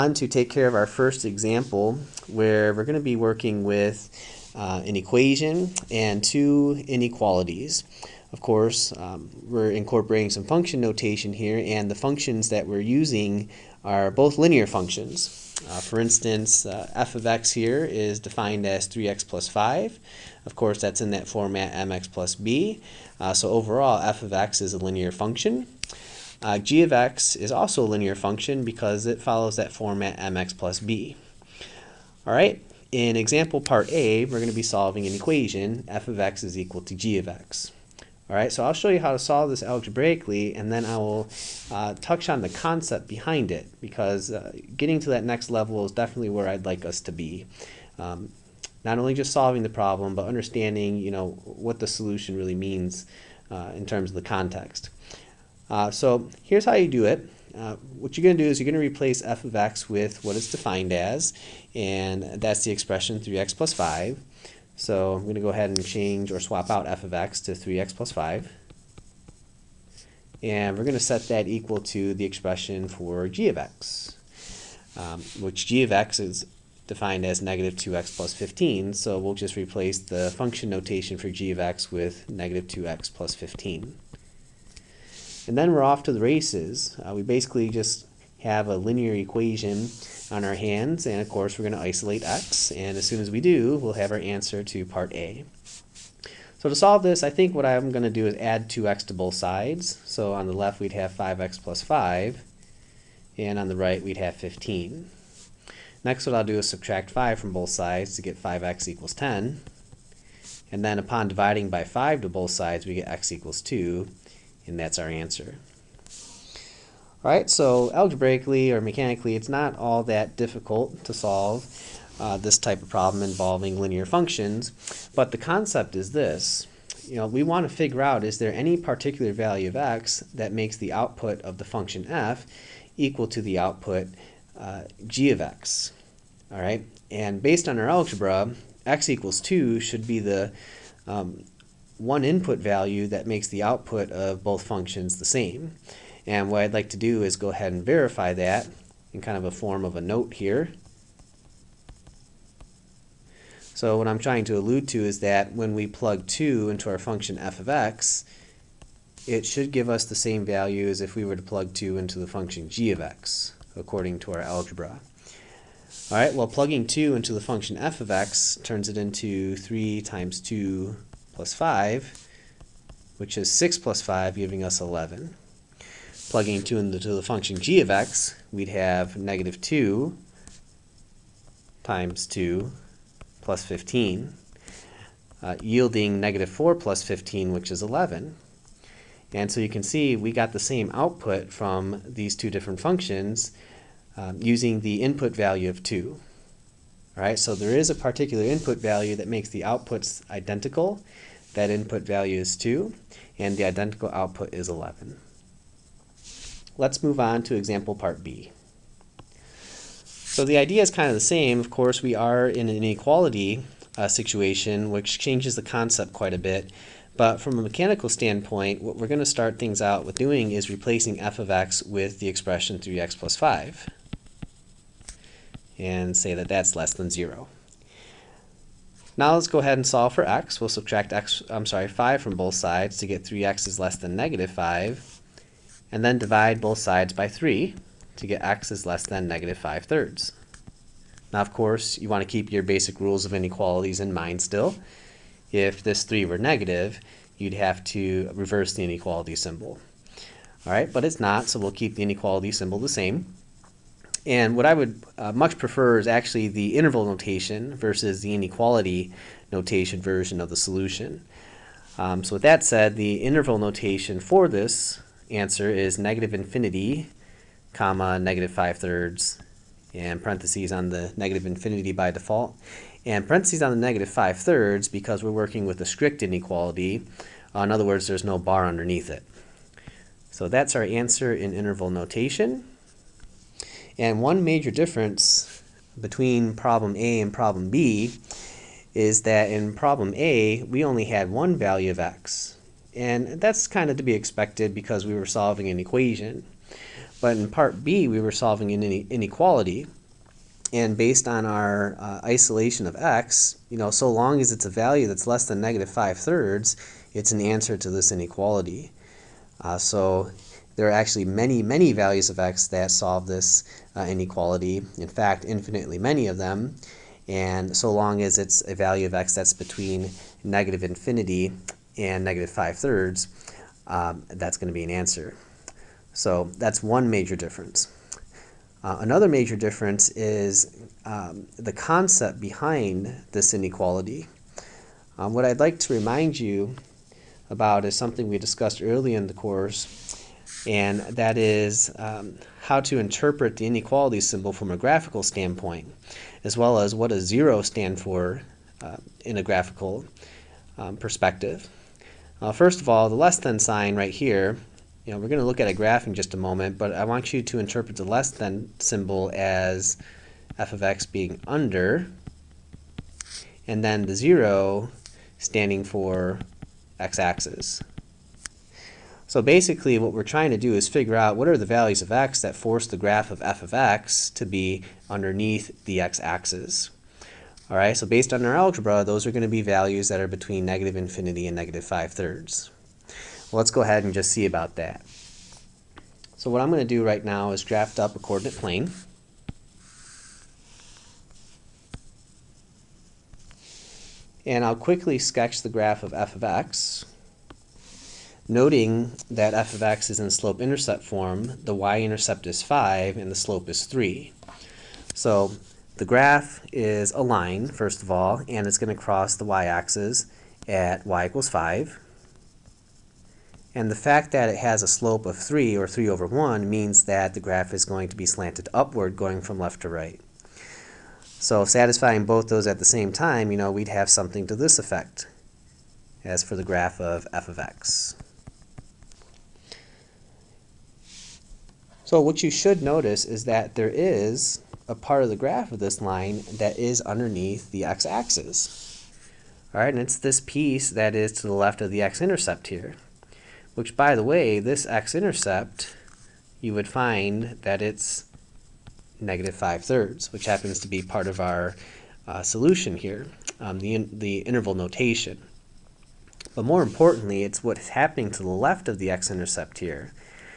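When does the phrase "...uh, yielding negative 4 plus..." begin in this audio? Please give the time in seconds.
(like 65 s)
185 s.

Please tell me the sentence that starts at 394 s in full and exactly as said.
And I'll quickly sketch the graph of f of x.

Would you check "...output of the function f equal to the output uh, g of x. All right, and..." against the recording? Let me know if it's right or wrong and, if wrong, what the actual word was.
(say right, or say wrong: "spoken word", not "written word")
right.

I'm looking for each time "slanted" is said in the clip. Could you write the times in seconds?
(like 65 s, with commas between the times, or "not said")
418 s.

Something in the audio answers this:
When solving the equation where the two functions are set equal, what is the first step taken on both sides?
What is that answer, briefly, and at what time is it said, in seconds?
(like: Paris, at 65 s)
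Add 2x, at 98 s.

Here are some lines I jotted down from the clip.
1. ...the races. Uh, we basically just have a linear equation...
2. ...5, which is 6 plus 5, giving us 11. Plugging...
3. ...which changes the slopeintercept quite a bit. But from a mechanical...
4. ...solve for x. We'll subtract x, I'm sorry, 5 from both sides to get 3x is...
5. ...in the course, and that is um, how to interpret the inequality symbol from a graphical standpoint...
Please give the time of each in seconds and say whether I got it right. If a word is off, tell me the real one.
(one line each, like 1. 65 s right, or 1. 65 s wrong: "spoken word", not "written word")
1. 86 s right
2. 171 s right
3. 214 s wrong: "concept", not "slopeintercept"
4. 229 s right
5. 339 s right.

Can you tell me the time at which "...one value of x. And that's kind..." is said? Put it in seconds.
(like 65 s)
291 s.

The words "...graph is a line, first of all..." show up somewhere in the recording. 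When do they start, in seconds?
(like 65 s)
406 s.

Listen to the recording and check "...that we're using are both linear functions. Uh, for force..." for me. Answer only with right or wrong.
wrong.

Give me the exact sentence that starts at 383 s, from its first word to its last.
Well, let's go ahead and just see about that.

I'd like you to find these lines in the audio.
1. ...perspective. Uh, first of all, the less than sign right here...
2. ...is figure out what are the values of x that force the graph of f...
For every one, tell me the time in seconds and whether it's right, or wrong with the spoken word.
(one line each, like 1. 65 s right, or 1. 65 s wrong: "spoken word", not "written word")
1. 350 s right
2. 370 s right.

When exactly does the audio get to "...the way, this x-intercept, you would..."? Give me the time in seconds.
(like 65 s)
444 s.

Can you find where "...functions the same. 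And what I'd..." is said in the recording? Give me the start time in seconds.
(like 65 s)
144 s.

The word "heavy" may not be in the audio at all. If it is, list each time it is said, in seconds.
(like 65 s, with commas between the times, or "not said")
not said.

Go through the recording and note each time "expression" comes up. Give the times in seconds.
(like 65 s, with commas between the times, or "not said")
62 s, 72 s, 222 s.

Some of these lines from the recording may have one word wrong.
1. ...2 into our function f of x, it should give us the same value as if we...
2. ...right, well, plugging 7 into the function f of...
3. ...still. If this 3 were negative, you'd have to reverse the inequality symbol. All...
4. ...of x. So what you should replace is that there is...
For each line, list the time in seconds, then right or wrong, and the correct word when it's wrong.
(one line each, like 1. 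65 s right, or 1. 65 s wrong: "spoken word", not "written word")
1. 156 s right
2. 166 s wrong: "2", not "7"
3. 244 s right
4. 427 s wrong: "notice", not "replace".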